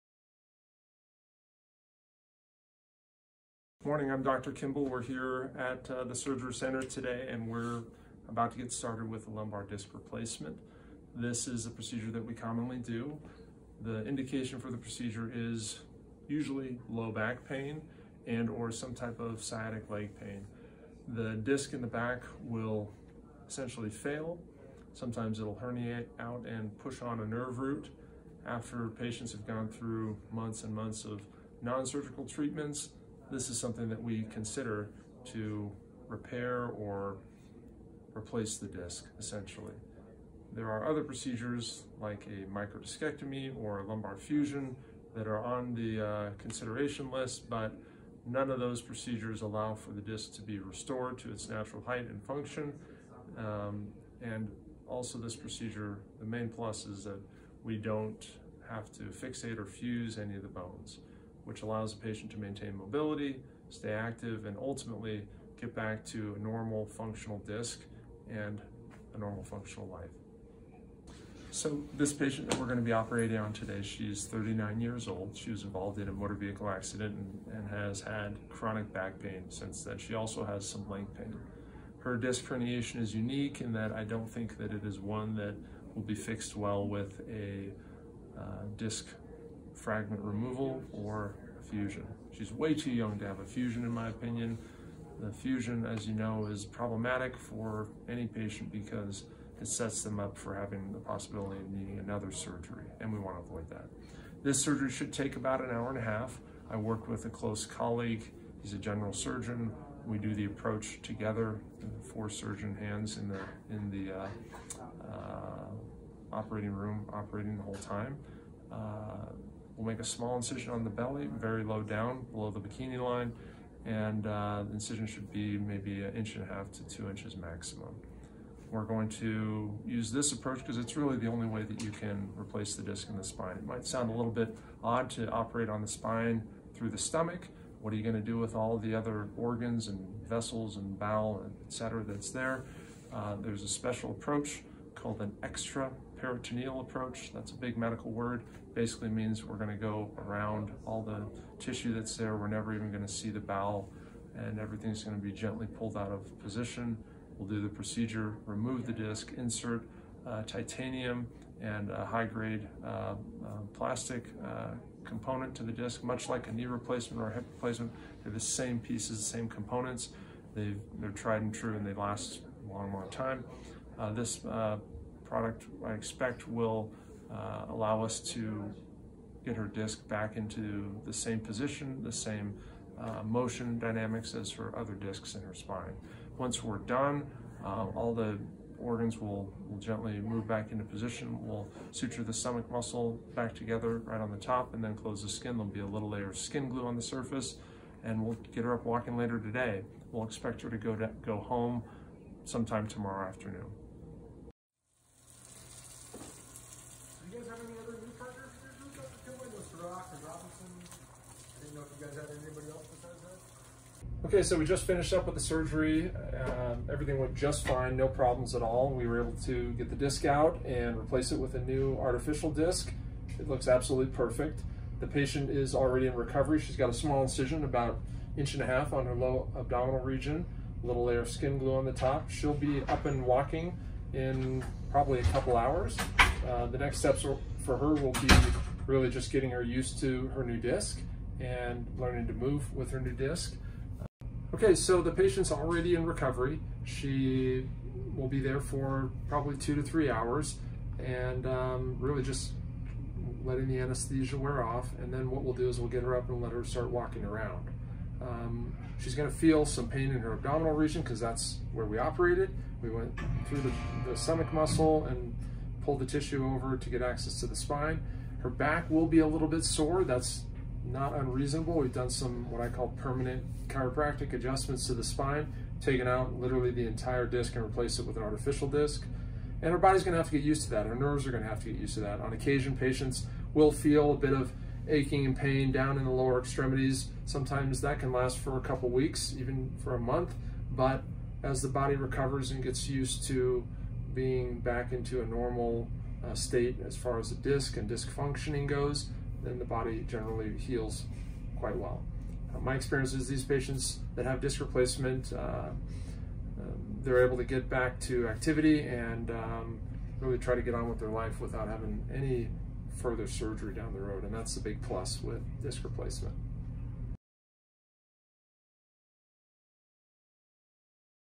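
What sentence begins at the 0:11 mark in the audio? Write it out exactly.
This is a procedure that we commonly do.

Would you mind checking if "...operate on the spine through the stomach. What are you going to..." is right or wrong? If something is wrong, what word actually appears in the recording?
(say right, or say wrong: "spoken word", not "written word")
right.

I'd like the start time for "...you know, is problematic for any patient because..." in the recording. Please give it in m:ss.
1:36.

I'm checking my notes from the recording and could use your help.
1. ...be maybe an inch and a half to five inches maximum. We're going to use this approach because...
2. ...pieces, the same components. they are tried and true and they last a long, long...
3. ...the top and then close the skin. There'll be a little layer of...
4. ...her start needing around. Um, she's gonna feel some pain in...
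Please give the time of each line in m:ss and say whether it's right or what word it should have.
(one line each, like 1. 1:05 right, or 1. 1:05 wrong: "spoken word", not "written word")
1. 2:05 wrong: "two", not "five"
2. 2:48 right
3. 3:14 right
4. 4:16 wrong: "walking", not "needing".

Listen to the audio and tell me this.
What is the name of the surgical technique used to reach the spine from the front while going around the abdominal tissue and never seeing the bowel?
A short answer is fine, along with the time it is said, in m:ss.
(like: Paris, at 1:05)
extra peritoneal approach, at 2:25.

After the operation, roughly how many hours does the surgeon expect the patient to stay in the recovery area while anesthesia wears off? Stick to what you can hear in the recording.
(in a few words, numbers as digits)
2 to 3 hours.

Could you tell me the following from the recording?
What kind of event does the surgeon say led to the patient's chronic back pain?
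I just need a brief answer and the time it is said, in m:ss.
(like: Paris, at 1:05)
motor vehicle accident, at 1:16.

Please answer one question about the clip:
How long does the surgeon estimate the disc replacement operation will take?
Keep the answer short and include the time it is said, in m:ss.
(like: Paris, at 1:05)
an hour and a half, at 1:45.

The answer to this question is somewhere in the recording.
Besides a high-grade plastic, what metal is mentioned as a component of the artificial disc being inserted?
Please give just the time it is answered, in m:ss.
2:40.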